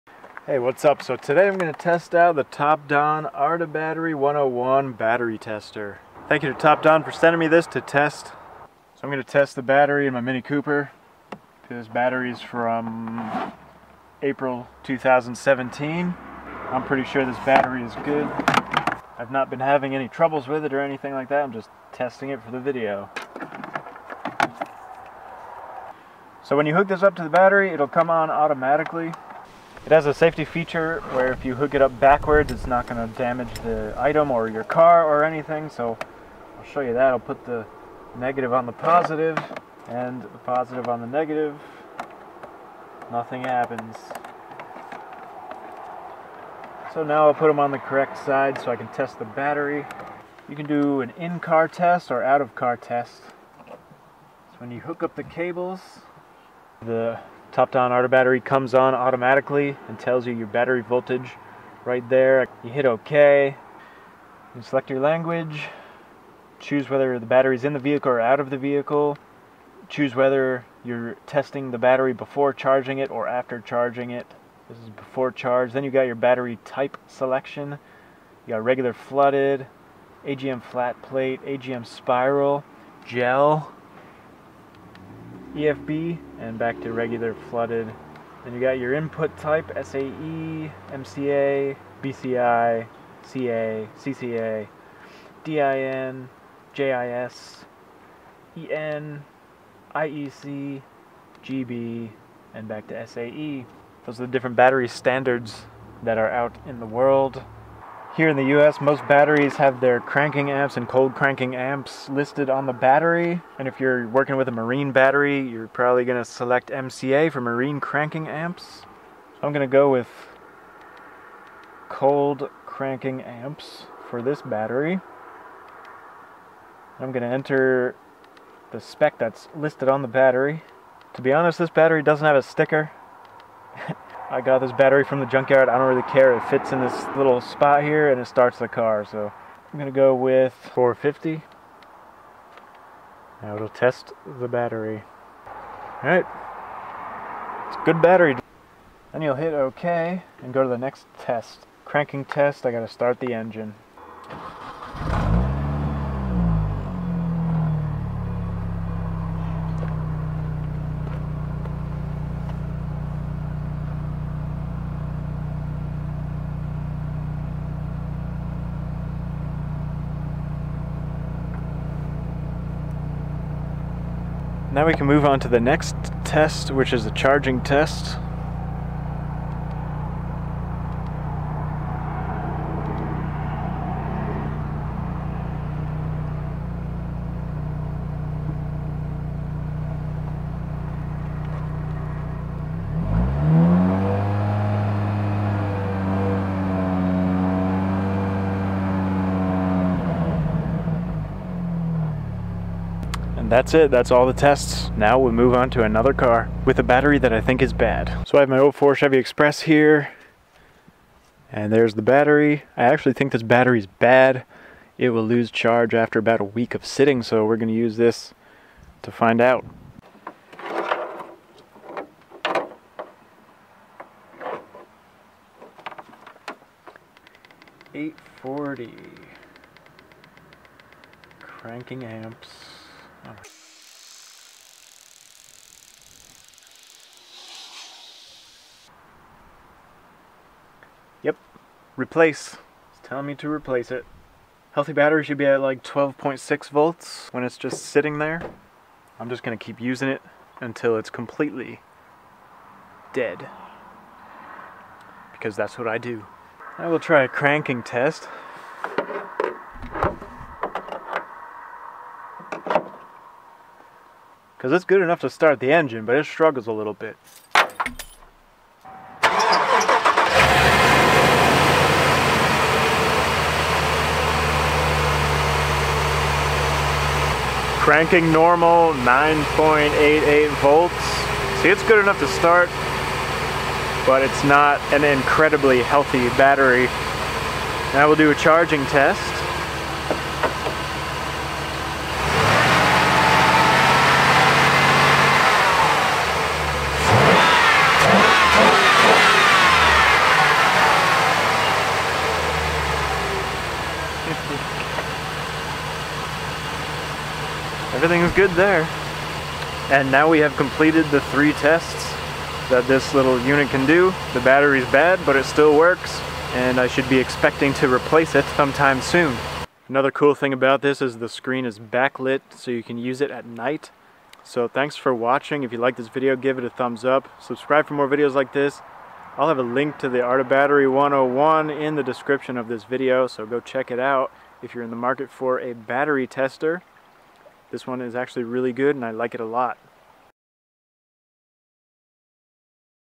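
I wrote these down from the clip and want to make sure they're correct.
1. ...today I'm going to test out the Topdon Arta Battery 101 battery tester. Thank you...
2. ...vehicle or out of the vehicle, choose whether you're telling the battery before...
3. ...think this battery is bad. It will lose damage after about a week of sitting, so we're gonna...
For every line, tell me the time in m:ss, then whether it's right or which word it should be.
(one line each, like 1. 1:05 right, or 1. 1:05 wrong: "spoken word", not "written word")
1. 0:01 right
2. 1:07 wrong: "testing", not "telling"
3. 3:33 wrong: "charge", not "damage".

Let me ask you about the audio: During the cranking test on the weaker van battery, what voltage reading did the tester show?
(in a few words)
9.88 volts.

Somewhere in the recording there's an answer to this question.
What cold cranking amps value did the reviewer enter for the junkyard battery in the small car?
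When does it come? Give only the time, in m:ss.
2:20.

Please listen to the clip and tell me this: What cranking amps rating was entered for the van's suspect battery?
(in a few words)
840.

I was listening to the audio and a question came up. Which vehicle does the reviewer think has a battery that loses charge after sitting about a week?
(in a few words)
04 Chevy Express.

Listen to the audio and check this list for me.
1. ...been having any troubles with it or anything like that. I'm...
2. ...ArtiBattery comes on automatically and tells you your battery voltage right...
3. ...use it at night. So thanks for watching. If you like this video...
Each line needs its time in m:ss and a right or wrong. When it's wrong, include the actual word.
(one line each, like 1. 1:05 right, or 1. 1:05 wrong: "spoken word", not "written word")
1. 0:19 right
2. 0:57 right
3. 5:22 right.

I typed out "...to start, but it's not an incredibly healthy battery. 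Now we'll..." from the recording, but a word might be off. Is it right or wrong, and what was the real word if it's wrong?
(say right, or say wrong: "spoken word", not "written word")
right.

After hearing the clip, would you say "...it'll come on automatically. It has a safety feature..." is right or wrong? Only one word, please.
right.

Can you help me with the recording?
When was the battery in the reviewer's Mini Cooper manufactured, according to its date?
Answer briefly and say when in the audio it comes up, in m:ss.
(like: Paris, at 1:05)
April 2017, at 0:14.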